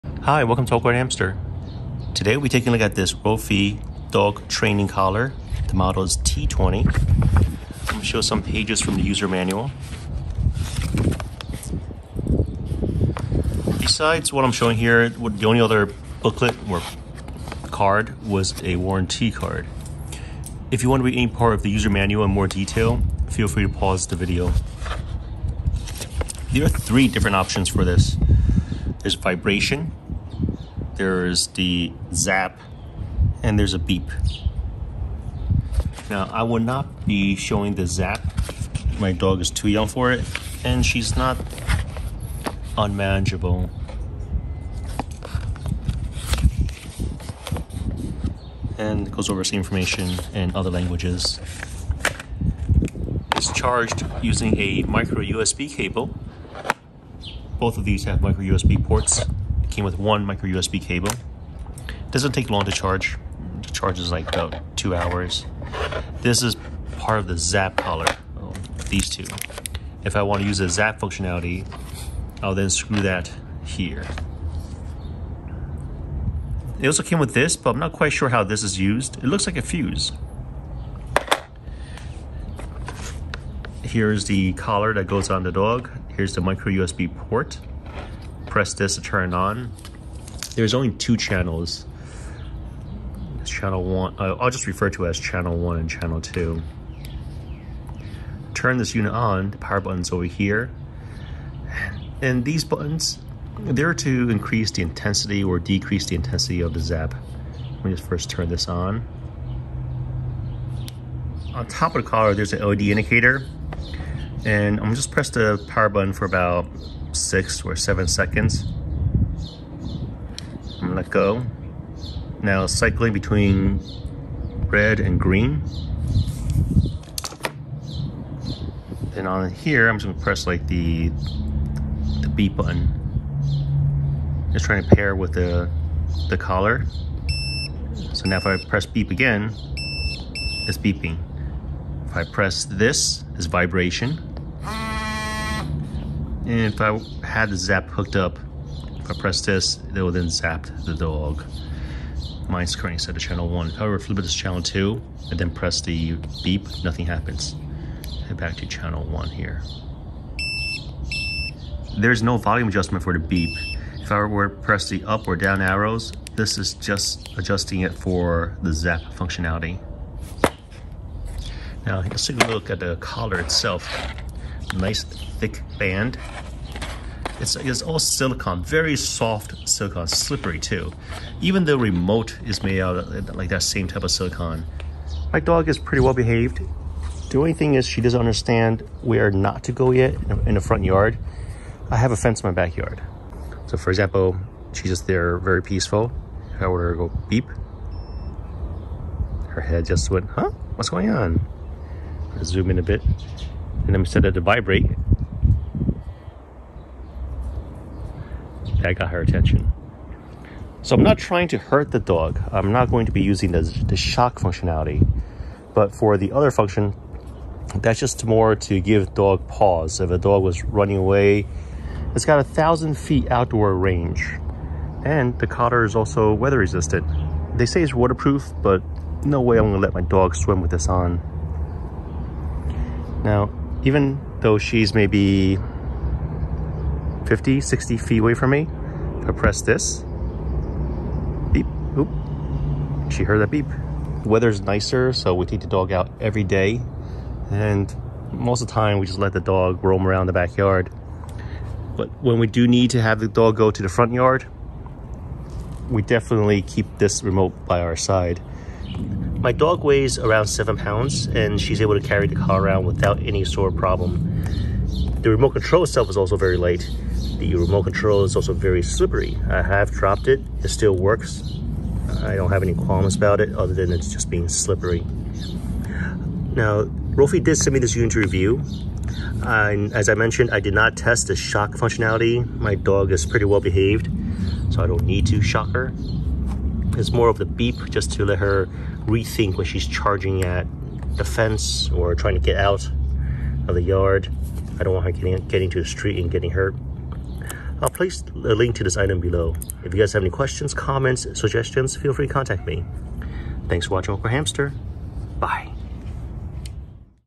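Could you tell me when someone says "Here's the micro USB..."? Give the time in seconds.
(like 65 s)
86 s.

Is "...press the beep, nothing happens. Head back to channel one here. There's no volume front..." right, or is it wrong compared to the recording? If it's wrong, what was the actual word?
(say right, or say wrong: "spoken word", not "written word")
wrong: "adjustment", not "front".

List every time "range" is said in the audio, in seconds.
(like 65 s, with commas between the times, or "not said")
223 s.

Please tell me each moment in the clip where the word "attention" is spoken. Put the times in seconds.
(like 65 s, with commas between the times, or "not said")
209 s.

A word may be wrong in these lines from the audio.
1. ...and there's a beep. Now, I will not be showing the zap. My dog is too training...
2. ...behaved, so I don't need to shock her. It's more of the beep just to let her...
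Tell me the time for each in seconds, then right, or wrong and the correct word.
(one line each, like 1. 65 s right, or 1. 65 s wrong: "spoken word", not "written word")
1. 33 s wrong: "young", not "training"
2. 283 s right.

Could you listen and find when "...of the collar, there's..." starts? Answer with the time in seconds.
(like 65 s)
111 s.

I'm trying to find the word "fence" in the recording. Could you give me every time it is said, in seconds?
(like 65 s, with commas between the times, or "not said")
192 s, 291 s.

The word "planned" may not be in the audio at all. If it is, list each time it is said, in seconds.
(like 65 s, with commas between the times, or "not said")
not said.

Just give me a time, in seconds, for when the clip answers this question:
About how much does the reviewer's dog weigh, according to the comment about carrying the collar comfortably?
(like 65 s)
260 s.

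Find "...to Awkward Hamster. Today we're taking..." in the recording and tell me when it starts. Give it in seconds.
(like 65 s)
0 s.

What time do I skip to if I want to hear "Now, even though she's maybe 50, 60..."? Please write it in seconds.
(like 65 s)
233 s.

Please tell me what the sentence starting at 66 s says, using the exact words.
This is part of the Zap collar, oh, these two.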